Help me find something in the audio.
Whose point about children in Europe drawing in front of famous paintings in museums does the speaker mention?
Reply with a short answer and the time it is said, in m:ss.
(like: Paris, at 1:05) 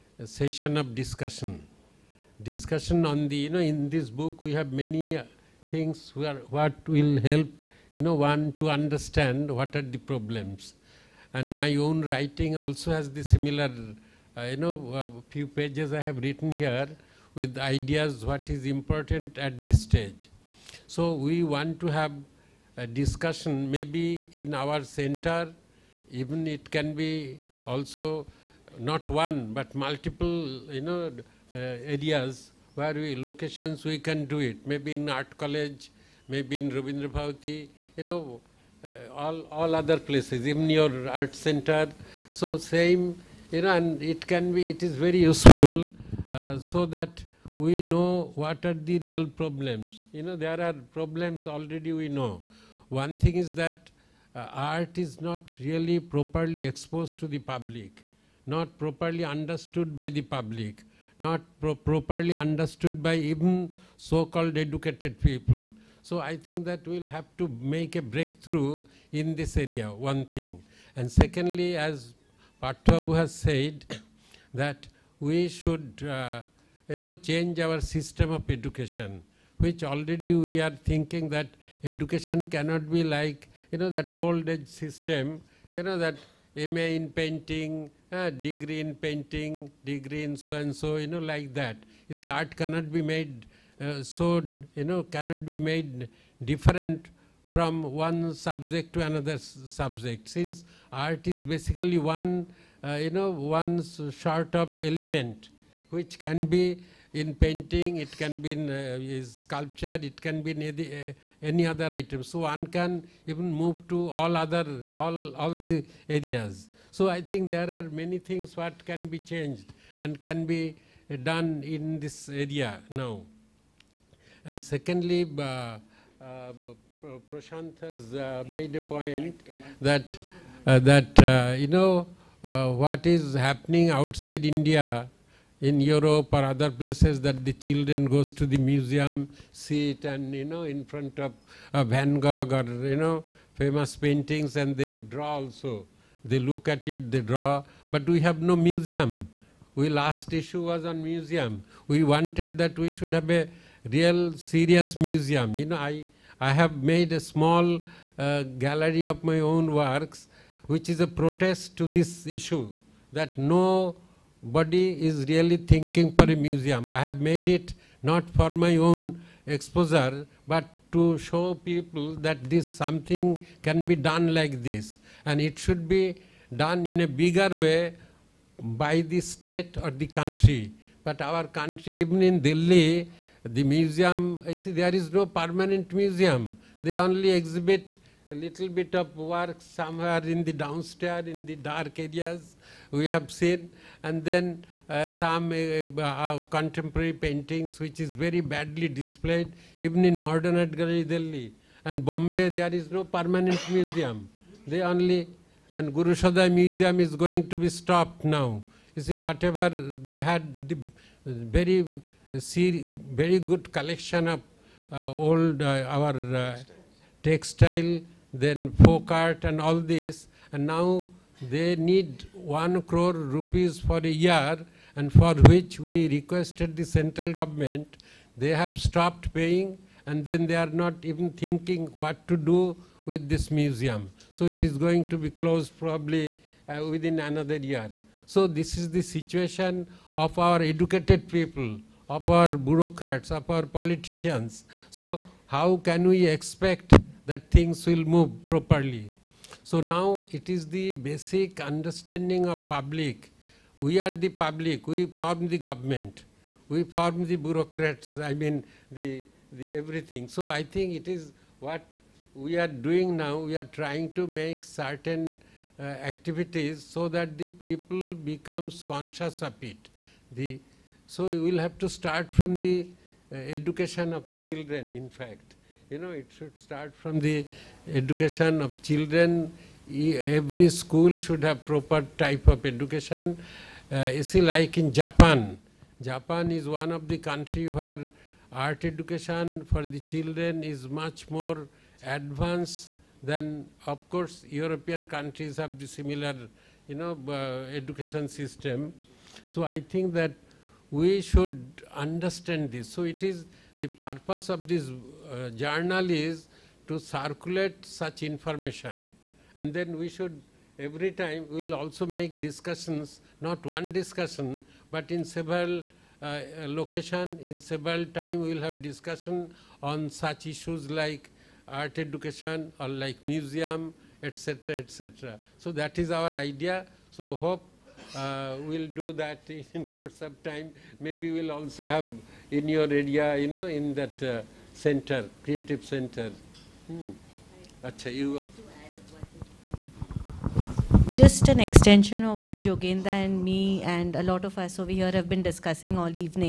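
Prashant, at 2:07.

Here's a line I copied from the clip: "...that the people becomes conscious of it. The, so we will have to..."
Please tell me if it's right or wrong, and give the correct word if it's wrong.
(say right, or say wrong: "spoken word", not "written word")
right.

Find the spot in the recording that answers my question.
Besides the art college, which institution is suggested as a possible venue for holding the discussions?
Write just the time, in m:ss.
0:36.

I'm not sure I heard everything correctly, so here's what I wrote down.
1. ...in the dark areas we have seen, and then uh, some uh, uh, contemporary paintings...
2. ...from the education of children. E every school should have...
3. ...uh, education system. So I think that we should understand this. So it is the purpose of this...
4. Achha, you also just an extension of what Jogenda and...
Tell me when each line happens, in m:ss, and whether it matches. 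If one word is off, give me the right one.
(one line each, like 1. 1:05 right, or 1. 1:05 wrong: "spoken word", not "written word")
1. 3:11 right
2. 4:36 right
3. 4:57 right
4. 5:37 right.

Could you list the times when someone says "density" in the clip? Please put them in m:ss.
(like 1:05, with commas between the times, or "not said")
not said.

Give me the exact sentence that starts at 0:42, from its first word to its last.
So same, you know, and it can be, it is very useful uh, so that we know what are the real problems.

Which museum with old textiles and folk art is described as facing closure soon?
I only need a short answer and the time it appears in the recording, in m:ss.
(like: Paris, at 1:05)
Gurusaday Museum, at 3:25.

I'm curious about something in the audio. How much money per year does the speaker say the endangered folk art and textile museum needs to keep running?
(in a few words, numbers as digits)
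1 crore rupees.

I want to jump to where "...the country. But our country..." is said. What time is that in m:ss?
2:59.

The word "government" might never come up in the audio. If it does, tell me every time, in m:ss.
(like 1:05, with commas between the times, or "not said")
3:47, 4:15.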